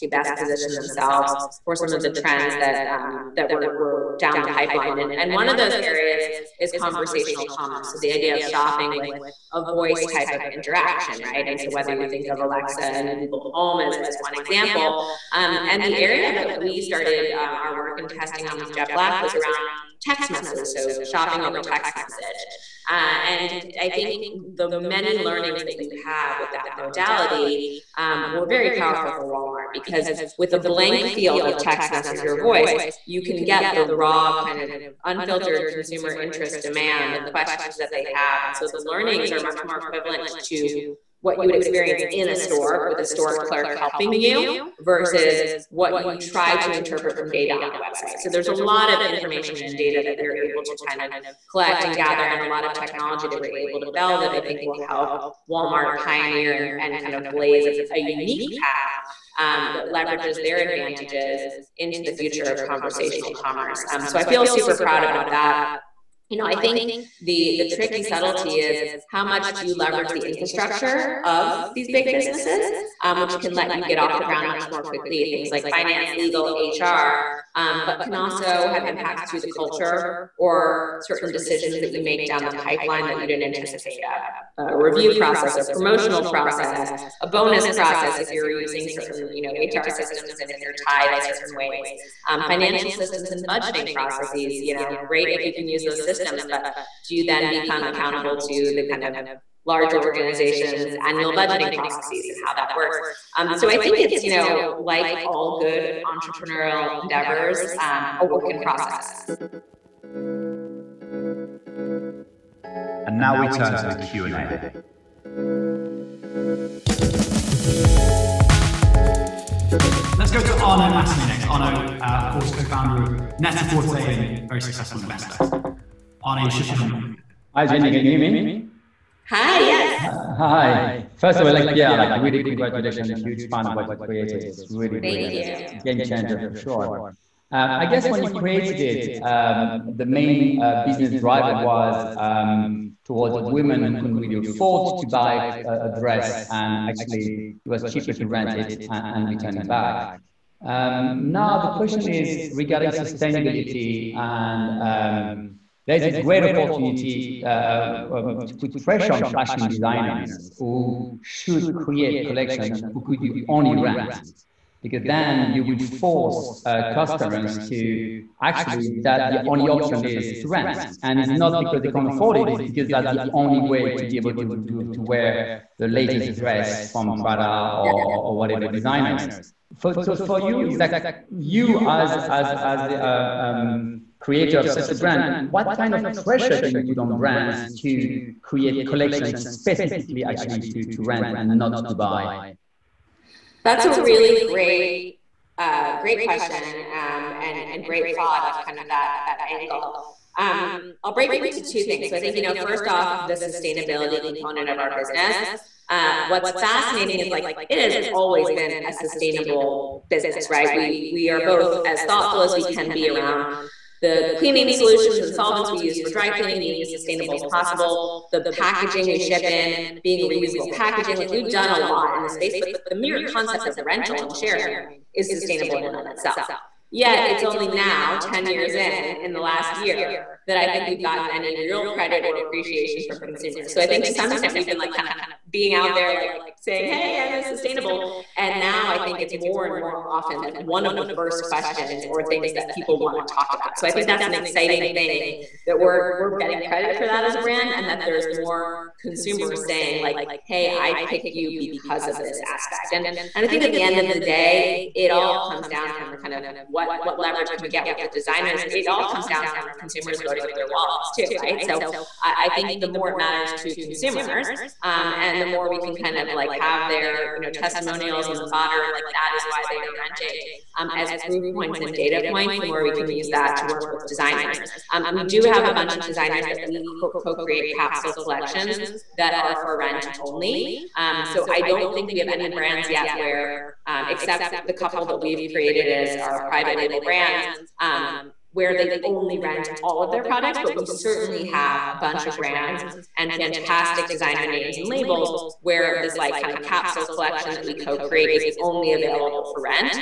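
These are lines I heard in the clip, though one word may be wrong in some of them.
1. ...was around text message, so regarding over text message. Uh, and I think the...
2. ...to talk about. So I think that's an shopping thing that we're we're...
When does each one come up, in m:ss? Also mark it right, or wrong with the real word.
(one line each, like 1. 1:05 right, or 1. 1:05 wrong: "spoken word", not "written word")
1. 0:19 wrong: "shopping", not "regarding"
2. 4:03 wrong: "exciting", not "shopping".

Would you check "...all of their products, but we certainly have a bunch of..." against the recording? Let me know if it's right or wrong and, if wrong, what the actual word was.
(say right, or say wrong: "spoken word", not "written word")
right.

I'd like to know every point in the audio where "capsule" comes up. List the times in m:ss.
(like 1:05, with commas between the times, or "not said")
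4:37, 4:56.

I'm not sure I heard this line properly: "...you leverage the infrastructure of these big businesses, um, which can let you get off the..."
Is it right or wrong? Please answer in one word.
right.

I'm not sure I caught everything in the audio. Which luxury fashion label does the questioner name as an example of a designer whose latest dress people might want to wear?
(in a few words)
Prada.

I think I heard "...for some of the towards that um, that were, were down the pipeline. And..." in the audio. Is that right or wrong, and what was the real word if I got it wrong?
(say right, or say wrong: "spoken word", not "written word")
wrong: "trends", not "towards".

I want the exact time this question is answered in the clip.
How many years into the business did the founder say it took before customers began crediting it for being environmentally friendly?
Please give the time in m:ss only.
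3:48.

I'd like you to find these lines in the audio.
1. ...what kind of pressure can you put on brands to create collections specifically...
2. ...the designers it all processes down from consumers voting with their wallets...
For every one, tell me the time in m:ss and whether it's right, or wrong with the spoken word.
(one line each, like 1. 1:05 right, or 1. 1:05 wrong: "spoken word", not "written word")
1. 3:05 right
2. 4:18 wrong: "comes", not "processes".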